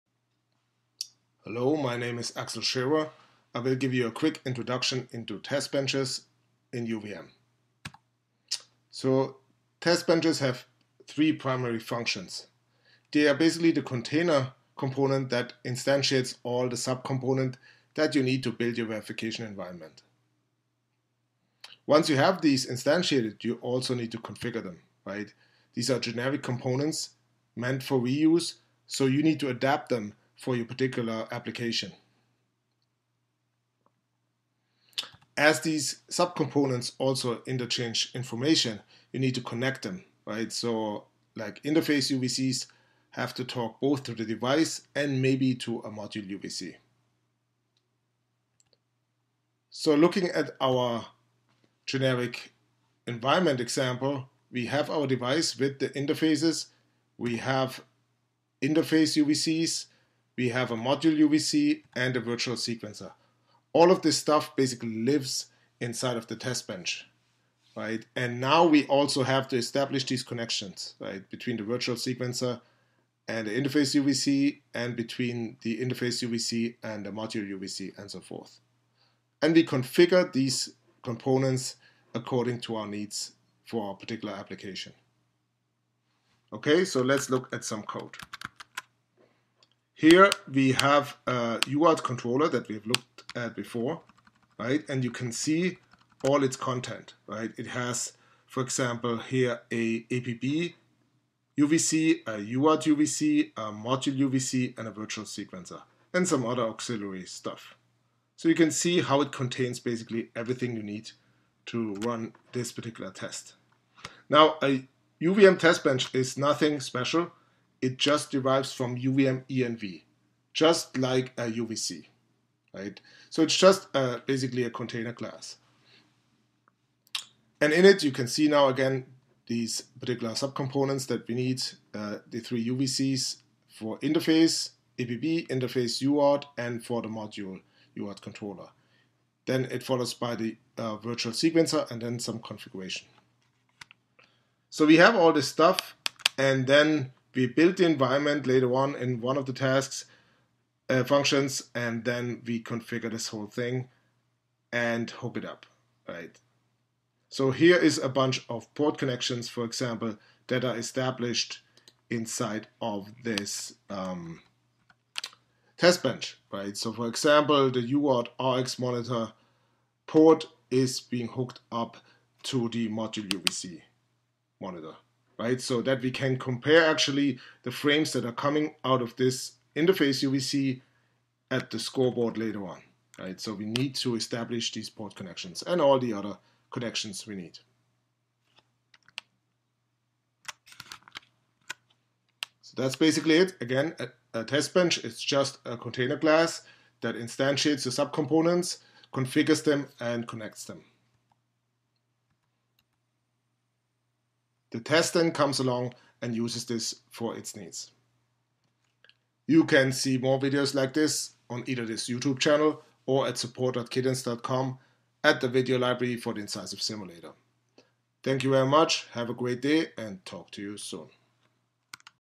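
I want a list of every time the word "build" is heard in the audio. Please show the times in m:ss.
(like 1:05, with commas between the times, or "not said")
0:18, 2:27.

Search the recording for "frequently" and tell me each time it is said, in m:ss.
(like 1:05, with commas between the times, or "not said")
not said.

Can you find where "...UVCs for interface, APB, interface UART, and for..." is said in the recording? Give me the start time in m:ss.
2:12.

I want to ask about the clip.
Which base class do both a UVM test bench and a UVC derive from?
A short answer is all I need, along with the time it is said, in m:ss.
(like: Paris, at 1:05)
UVM ENV, at 1:58.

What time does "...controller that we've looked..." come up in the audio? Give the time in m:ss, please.
1:32.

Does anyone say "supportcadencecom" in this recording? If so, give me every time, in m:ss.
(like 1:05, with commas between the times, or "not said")
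3:33.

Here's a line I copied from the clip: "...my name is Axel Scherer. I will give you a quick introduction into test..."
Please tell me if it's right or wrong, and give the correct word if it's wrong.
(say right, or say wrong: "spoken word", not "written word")
right.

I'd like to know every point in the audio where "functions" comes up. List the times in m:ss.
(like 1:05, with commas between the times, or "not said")
0:11, 2:31.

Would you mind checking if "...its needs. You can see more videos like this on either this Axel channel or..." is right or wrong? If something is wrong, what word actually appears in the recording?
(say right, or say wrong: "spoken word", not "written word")
wrong: "YouTube", not "Axel".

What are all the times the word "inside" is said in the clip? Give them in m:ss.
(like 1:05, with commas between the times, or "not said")
1:05, 2:42.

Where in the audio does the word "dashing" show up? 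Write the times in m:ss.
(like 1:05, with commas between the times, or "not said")
not said.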